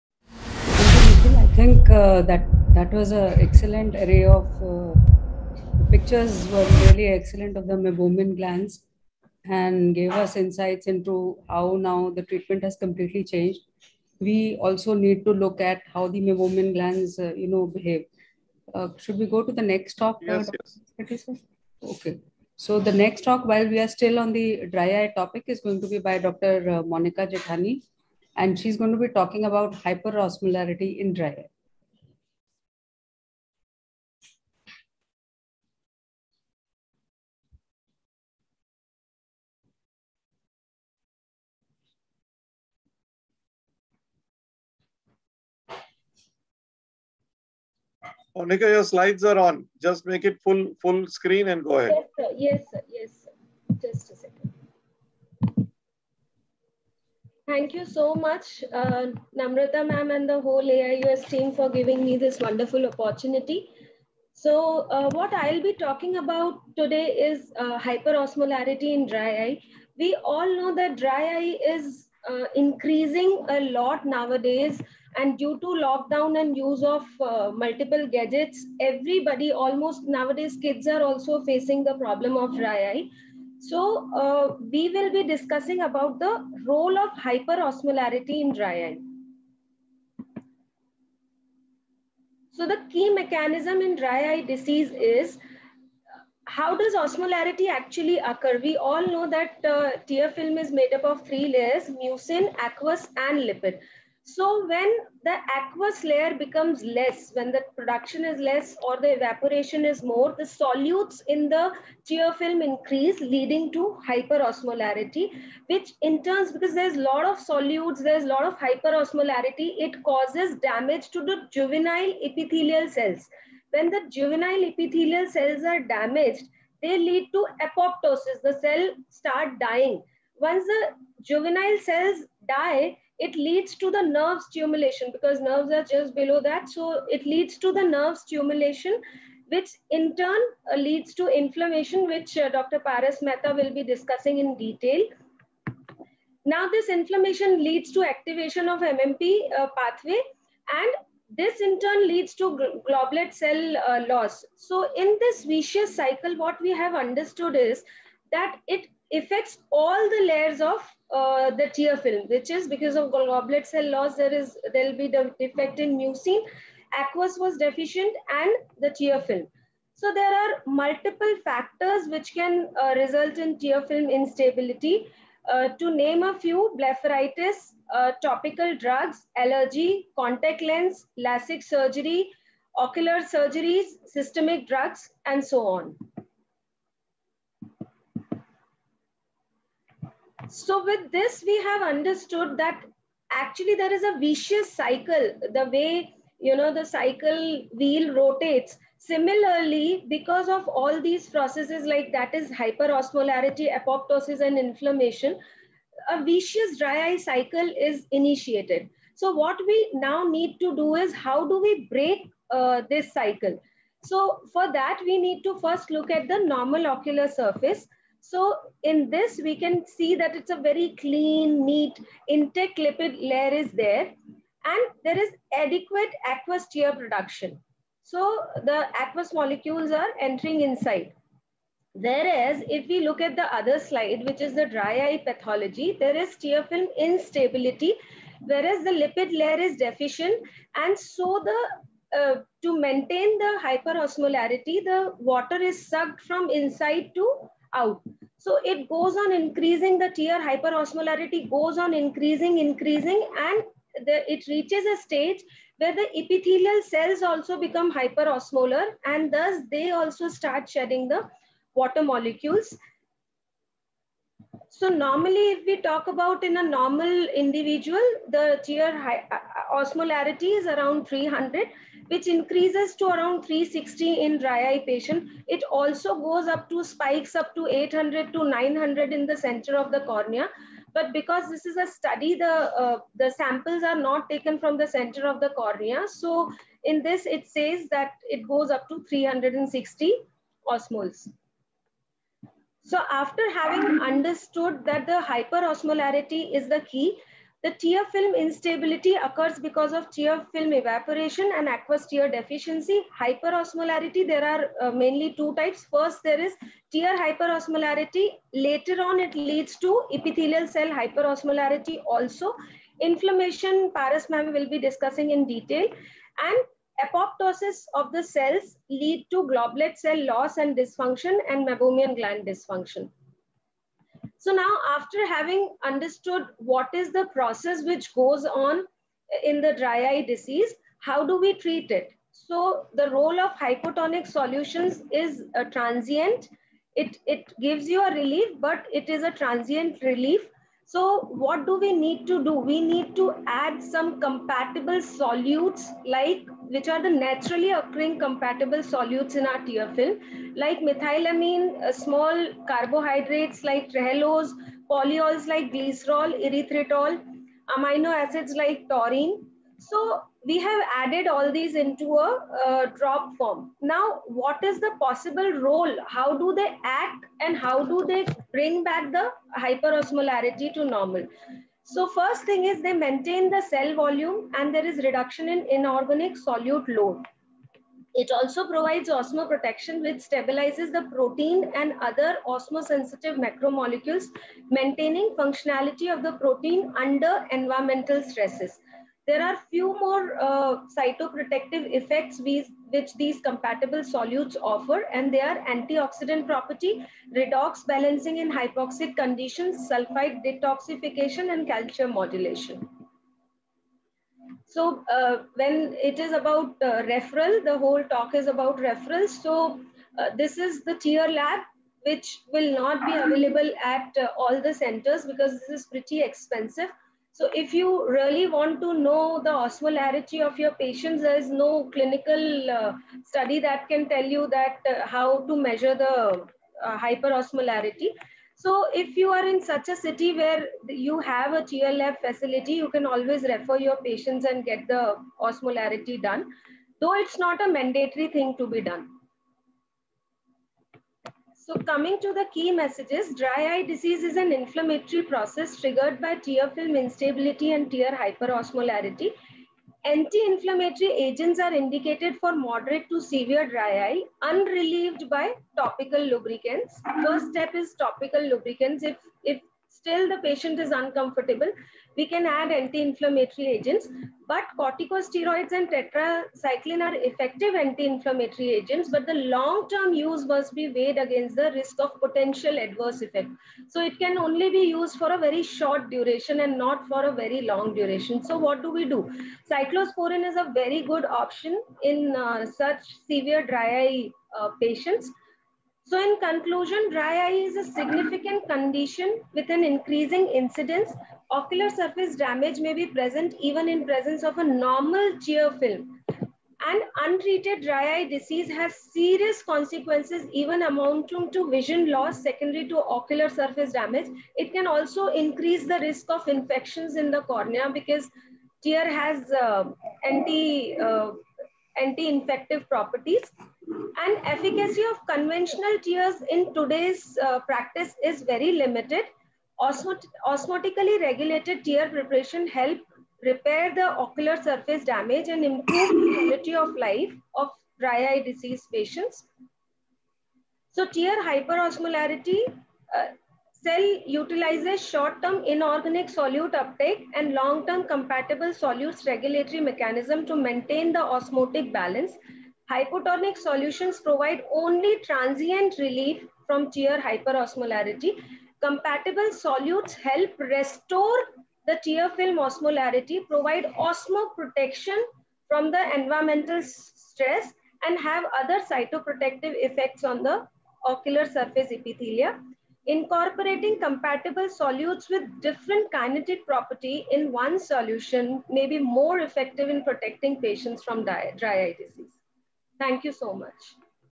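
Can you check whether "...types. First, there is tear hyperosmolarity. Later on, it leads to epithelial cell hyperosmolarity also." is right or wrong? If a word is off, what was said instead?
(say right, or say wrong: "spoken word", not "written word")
right.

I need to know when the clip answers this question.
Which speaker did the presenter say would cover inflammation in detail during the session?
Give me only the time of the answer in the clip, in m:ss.
2:22.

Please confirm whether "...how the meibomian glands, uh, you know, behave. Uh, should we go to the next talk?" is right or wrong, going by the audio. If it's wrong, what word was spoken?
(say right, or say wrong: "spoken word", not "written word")
right.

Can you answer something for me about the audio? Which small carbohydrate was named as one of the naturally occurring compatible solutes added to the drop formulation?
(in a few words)
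Trehalose.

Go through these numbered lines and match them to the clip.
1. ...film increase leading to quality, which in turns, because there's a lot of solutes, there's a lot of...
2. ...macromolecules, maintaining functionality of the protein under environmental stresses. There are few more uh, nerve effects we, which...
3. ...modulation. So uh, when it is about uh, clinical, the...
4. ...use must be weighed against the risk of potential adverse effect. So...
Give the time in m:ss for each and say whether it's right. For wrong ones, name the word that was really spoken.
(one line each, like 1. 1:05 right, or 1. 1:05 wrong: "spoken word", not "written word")
1. 1:52 wrong: "hyperosmolarity", not "quality"
2. 6:23 wrong: "cytoprotective", not "nerve"
3. 6:42 wrong: "referral", not "clinical"
4. 7:50 right.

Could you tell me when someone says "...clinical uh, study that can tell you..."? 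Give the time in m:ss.
7:01.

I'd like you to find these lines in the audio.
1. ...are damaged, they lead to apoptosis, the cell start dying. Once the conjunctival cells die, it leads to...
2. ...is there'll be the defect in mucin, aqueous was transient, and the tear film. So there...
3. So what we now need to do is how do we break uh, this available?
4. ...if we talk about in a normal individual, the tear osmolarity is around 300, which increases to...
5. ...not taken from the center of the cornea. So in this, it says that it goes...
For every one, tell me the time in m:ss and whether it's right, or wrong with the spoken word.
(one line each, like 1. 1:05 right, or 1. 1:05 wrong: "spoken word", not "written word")
1. 2:05 right
2. 2:44 wrong: "deficient", not "transient"
3. 3:29 wrong: "cycle", not "available"
4. 4:25 right
5. 4:43 right.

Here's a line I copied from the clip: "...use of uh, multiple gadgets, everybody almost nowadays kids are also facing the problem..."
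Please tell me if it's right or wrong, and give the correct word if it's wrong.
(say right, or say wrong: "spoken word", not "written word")
right.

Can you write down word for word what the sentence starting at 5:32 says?
So the role of hypotonic solutions is uh, transient.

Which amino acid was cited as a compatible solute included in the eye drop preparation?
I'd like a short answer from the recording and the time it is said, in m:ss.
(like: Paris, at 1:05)
Taurine, at 5:58.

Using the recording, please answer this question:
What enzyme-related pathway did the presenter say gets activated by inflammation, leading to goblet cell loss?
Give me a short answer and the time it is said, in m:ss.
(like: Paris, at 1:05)
MMP, at 2:28.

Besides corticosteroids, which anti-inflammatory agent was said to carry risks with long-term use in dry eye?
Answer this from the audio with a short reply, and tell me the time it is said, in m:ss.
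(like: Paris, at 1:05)
Tetracycline, at 7:45.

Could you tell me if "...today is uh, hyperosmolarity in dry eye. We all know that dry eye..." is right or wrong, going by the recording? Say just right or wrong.
right.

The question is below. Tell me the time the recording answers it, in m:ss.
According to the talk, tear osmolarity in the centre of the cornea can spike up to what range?
4:37.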